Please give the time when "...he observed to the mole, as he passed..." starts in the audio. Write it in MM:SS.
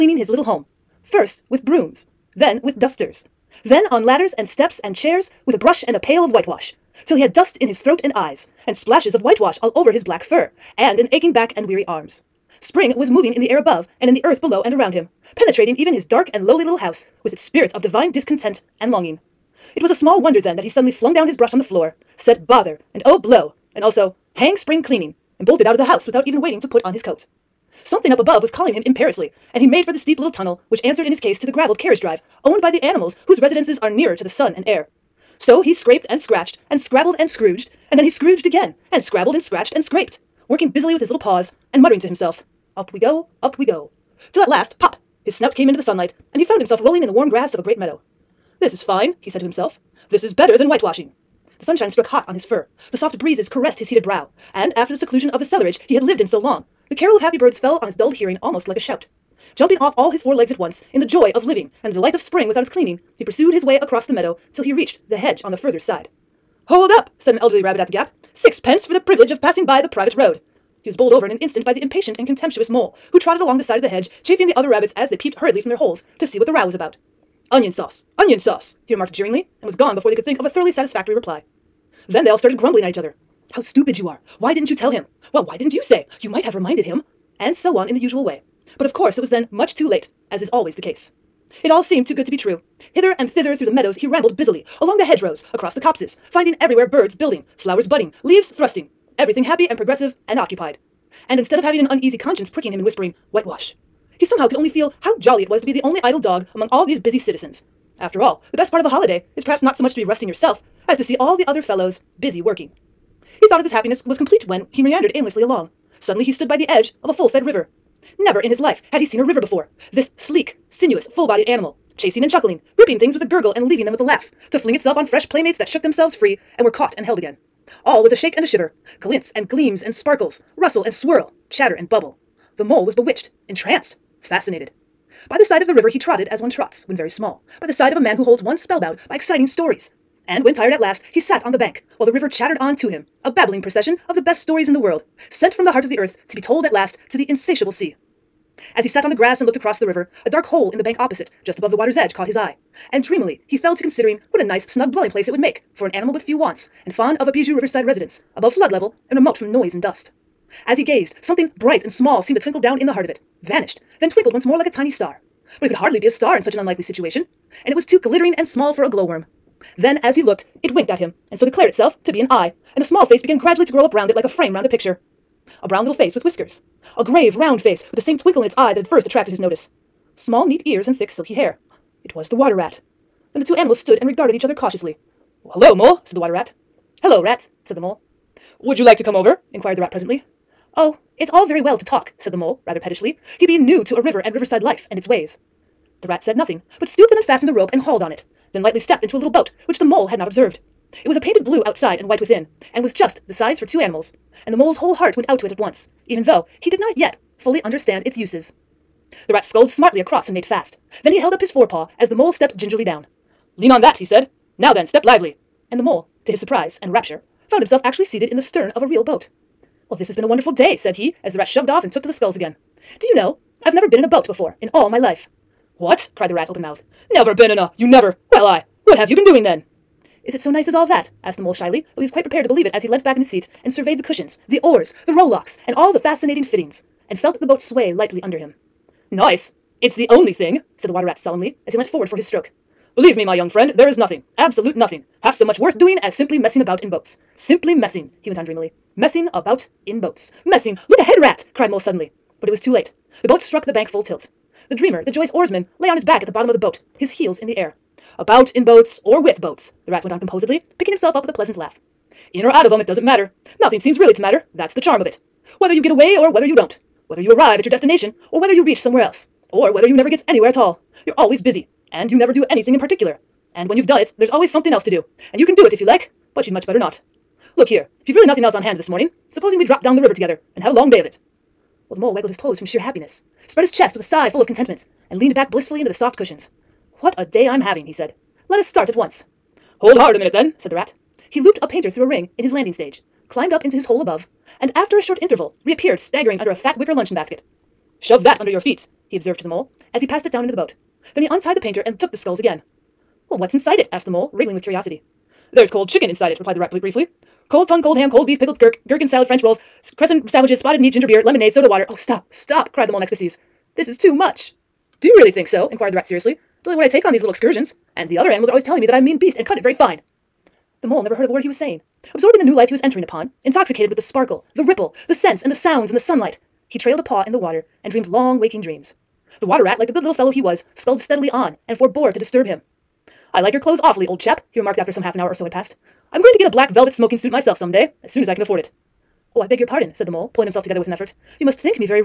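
04:59.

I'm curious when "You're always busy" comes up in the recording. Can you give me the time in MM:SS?
04:31.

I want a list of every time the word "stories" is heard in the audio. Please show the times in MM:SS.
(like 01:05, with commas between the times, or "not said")
02:19, 02:24.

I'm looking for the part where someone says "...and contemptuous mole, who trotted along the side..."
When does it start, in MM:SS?
01:12.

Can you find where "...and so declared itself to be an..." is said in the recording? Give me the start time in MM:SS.
02:51.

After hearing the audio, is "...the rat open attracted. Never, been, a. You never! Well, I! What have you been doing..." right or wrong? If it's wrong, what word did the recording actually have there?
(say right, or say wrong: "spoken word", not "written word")
wrong: "mouthed", not "attracted".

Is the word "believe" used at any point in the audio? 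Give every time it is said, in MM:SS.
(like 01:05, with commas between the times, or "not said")
03:52, 04:02.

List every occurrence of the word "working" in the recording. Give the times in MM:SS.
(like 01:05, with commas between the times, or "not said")
00:40, 01:52.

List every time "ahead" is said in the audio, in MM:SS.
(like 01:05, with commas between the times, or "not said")
04:10.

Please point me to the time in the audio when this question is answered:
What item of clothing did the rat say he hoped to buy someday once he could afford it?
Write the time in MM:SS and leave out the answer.
05:36.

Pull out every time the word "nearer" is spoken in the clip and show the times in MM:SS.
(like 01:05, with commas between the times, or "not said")
00:33.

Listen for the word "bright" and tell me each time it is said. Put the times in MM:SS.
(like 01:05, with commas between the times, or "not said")
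02:41.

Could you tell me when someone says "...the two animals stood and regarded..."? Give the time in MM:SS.
03:03.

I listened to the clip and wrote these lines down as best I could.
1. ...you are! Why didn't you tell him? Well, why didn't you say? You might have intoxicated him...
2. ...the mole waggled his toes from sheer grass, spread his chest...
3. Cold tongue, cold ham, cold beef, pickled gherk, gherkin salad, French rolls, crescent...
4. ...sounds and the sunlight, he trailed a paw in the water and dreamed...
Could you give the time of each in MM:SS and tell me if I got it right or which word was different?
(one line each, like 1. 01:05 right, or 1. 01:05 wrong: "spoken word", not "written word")
1. 01:23 wrong: "reminded", not "intoxicated"
2. 04:41 wrong: "happiness", not "grass"
3. 05:07 right
4. 05:25 right.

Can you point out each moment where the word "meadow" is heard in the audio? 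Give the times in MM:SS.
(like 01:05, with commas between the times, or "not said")
00:47, 01:04, 01:33.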